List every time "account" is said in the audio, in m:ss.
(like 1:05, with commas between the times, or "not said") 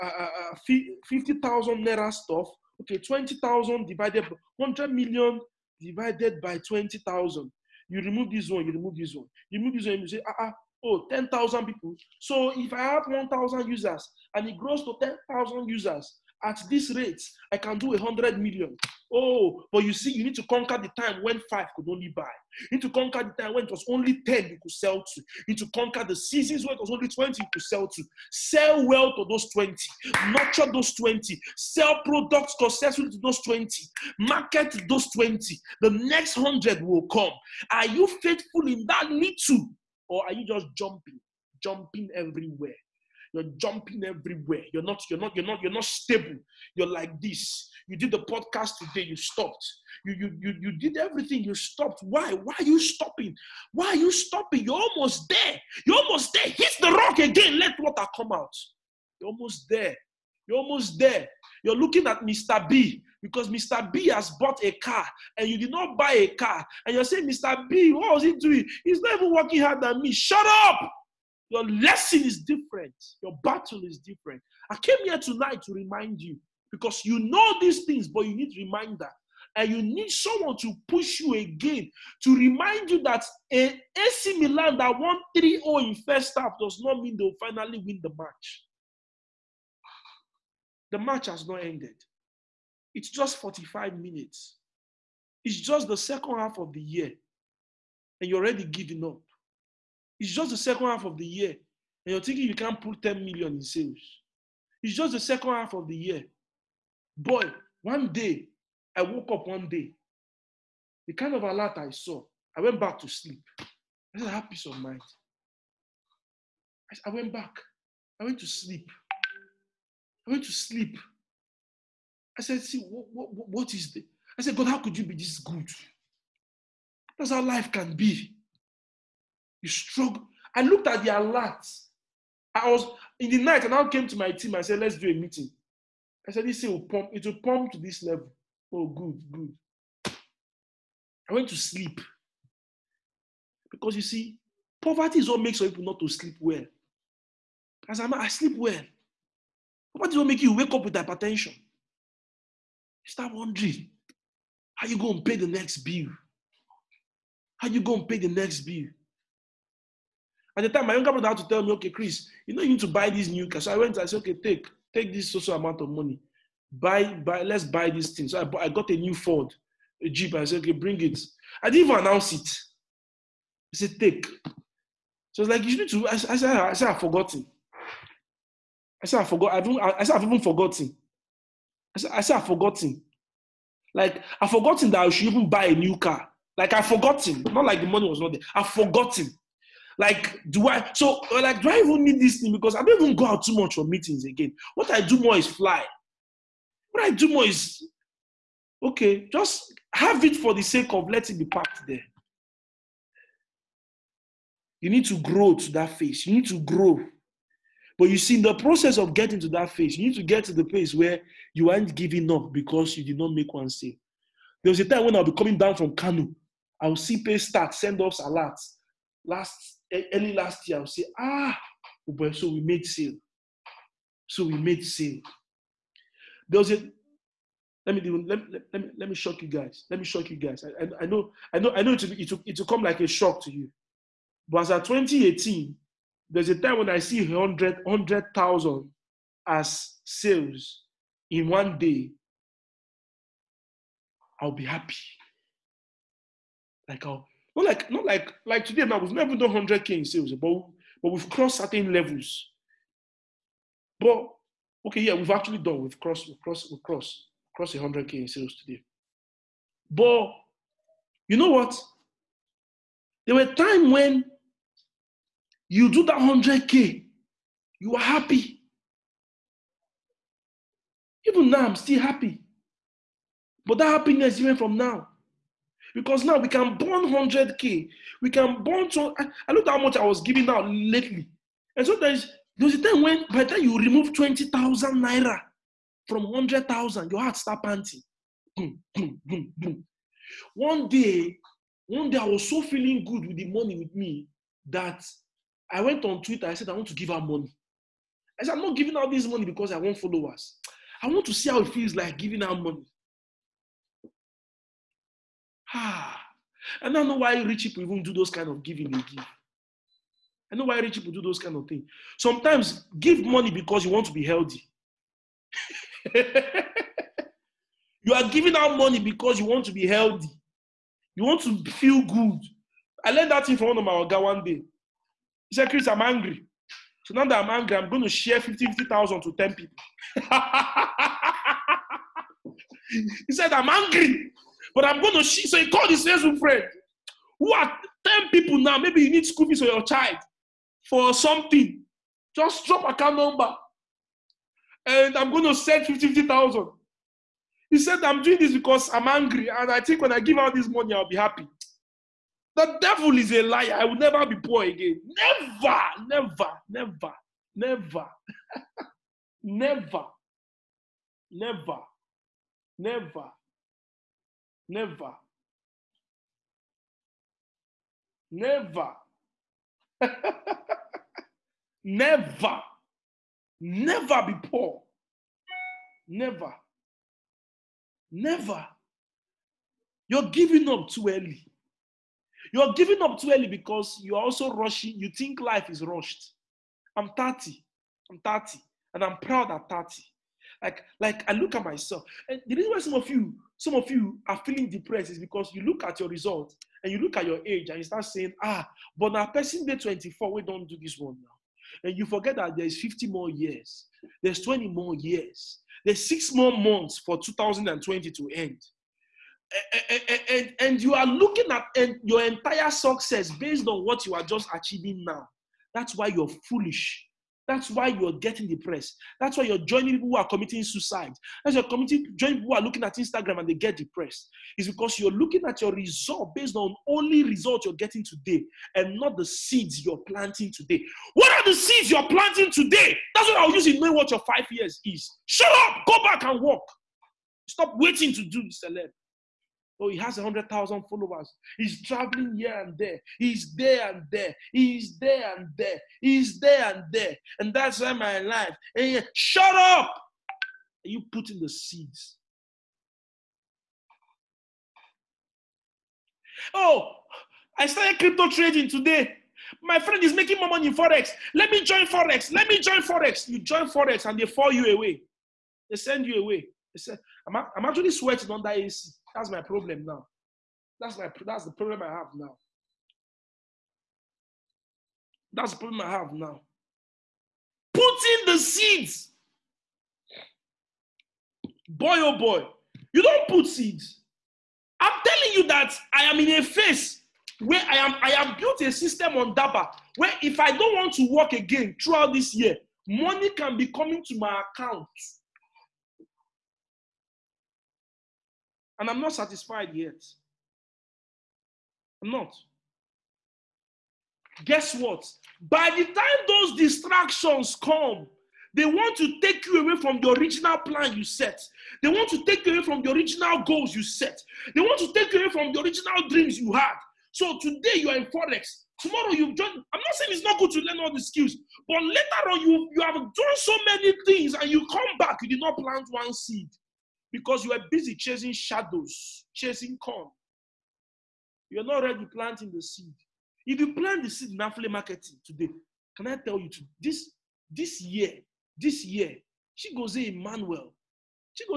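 5:42, 8:14.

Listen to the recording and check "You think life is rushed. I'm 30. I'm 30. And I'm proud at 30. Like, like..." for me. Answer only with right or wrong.
right.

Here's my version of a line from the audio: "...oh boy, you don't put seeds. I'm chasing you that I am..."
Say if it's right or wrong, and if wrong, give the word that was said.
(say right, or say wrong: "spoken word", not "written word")
wrong: "telling", not "chasing".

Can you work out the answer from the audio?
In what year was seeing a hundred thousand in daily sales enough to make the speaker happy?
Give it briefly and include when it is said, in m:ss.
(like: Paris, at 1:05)
2018, at 3:54.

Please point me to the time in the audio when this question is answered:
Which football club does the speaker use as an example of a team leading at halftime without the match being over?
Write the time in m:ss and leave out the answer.
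1:23.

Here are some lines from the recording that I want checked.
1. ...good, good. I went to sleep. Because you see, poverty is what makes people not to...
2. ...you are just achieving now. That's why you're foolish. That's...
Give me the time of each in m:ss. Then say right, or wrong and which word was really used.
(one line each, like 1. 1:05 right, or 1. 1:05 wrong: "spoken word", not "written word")
1. 2:18 right
2. 6:54 right.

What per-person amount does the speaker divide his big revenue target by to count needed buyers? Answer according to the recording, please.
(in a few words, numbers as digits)
20,000.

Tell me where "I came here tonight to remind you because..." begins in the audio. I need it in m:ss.
1:14.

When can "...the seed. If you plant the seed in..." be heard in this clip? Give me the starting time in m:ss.
8:52.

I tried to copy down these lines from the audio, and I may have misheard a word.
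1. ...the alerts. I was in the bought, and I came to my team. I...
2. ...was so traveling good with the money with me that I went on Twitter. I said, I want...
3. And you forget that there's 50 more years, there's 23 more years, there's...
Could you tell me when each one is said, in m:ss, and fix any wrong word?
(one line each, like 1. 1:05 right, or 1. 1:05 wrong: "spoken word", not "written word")
1. 2:11 wrong: "night", not "bought"
2. 4:52 wrong: "feeling", not "traveling"
3. 6:41 wrong: "20", not "23".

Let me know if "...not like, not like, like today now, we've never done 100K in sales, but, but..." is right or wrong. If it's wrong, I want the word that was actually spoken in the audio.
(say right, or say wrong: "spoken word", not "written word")
right.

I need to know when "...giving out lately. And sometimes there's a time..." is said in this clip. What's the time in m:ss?
4:40.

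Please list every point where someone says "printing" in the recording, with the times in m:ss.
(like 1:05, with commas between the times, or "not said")
not said.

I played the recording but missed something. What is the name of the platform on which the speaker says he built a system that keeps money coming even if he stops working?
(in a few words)
Daba.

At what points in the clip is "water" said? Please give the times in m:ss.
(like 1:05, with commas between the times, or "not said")
0:57.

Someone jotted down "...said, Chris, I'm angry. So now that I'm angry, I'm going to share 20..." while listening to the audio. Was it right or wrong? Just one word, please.
wrong.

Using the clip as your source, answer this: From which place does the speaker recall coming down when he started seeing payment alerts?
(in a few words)
Kanu.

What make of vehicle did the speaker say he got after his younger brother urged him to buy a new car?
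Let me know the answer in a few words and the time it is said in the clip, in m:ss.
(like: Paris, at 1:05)
Ford, at 2:49.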